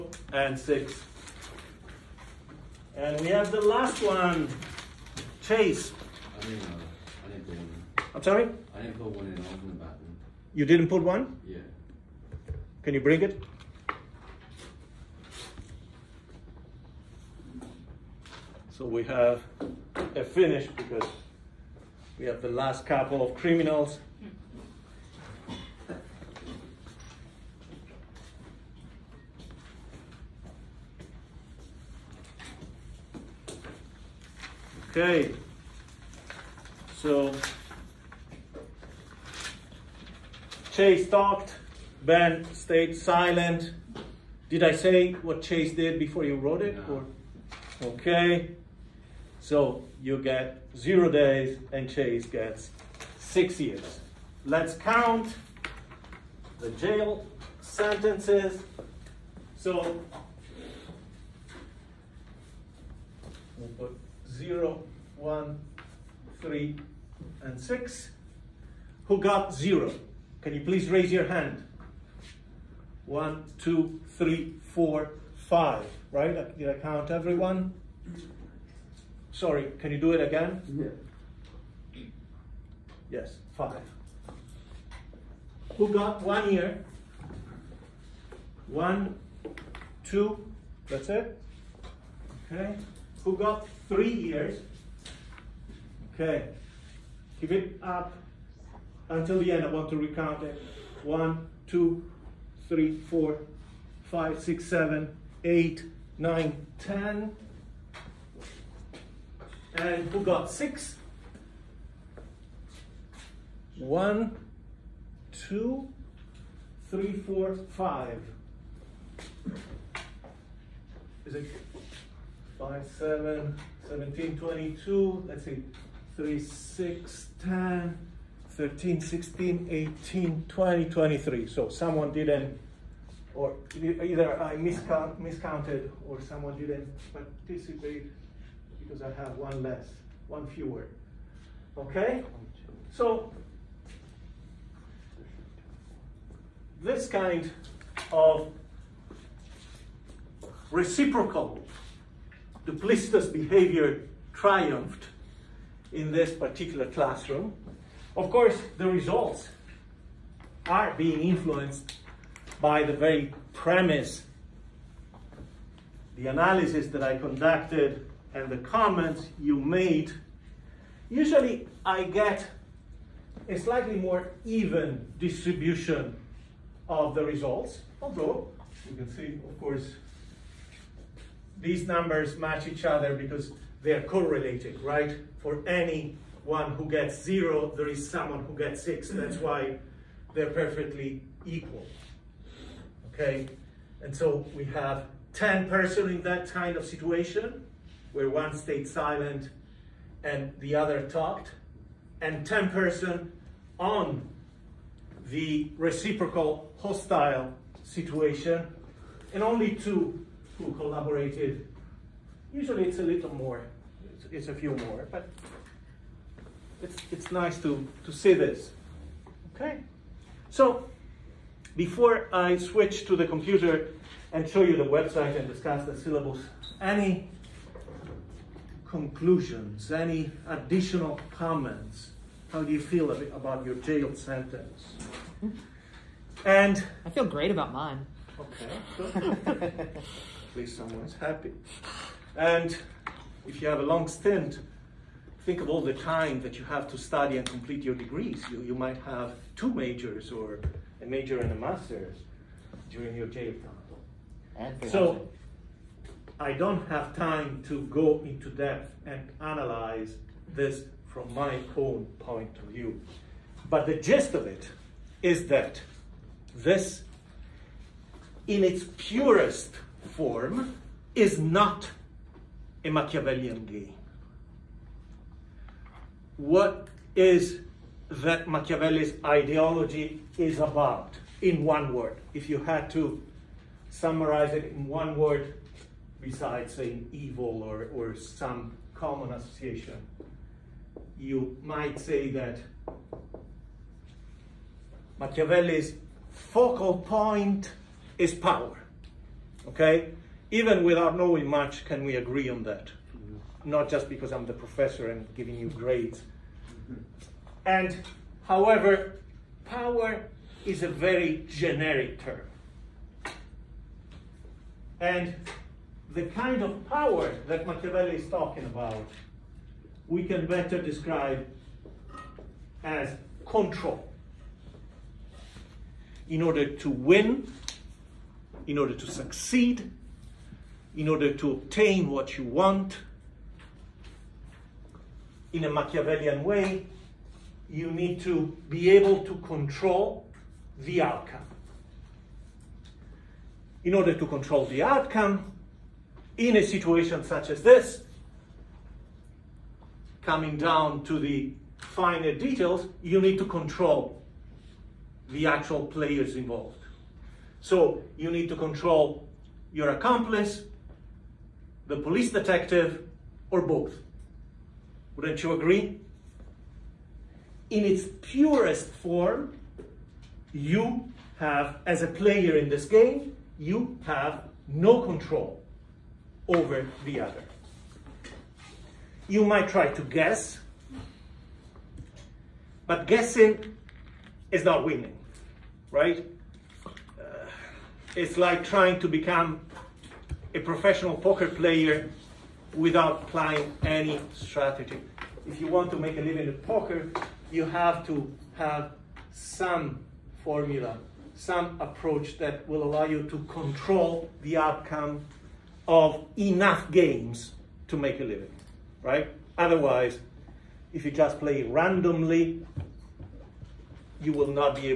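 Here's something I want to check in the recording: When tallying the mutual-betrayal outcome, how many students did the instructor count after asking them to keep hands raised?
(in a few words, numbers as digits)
10.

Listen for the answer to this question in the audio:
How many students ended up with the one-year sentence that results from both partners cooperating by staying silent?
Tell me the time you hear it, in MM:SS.
01:28.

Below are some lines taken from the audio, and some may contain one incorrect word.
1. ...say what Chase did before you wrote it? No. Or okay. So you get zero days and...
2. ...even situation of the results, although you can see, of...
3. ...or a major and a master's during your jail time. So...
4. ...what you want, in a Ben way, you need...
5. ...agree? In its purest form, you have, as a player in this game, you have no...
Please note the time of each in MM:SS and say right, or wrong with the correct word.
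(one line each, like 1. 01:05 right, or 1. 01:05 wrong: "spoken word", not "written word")
1. 00:44 right
2. 02:54 wrong: "distribution", not "situation"
3. 04:10 right
4. 05:32 wrong: "Machiavellian", not "Ben"
5. 06:05 right.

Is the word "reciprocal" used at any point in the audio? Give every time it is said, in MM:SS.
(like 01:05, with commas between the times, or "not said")
02:30, 03:25.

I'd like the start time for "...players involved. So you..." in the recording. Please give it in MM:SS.
05:55.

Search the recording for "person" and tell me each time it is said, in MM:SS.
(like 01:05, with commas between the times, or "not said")
03:15, 03:22.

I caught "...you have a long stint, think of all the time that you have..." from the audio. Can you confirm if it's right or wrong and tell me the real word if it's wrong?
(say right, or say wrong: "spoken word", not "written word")
right.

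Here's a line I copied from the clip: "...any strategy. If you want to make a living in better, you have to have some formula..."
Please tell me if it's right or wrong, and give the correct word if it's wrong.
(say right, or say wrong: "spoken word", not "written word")
wrong: "poker", not "better".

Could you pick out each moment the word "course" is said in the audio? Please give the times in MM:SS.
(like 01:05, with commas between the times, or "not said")
02:38, 02:59.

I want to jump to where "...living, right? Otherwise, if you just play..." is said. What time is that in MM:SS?
06:48.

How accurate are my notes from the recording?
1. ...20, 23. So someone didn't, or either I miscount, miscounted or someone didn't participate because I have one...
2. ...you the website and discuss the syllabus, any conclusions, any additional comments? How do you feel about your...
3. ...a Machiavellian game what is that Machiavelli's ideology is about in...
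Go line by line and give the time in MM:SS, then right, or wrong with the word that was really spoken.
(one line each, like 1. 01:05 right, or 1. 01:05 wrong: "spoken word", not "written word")
1. 02:10 right
2. 03:44 right
3. 04:32 right.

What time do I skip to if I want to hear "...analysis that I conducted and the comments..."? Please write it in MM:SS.
02:46.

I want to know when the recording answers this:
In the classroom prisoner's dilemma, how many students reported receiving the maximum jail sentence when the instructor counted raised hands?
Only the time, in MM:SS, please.
01:53.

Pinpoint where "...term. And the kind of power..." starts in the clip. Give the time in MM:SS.
05:12.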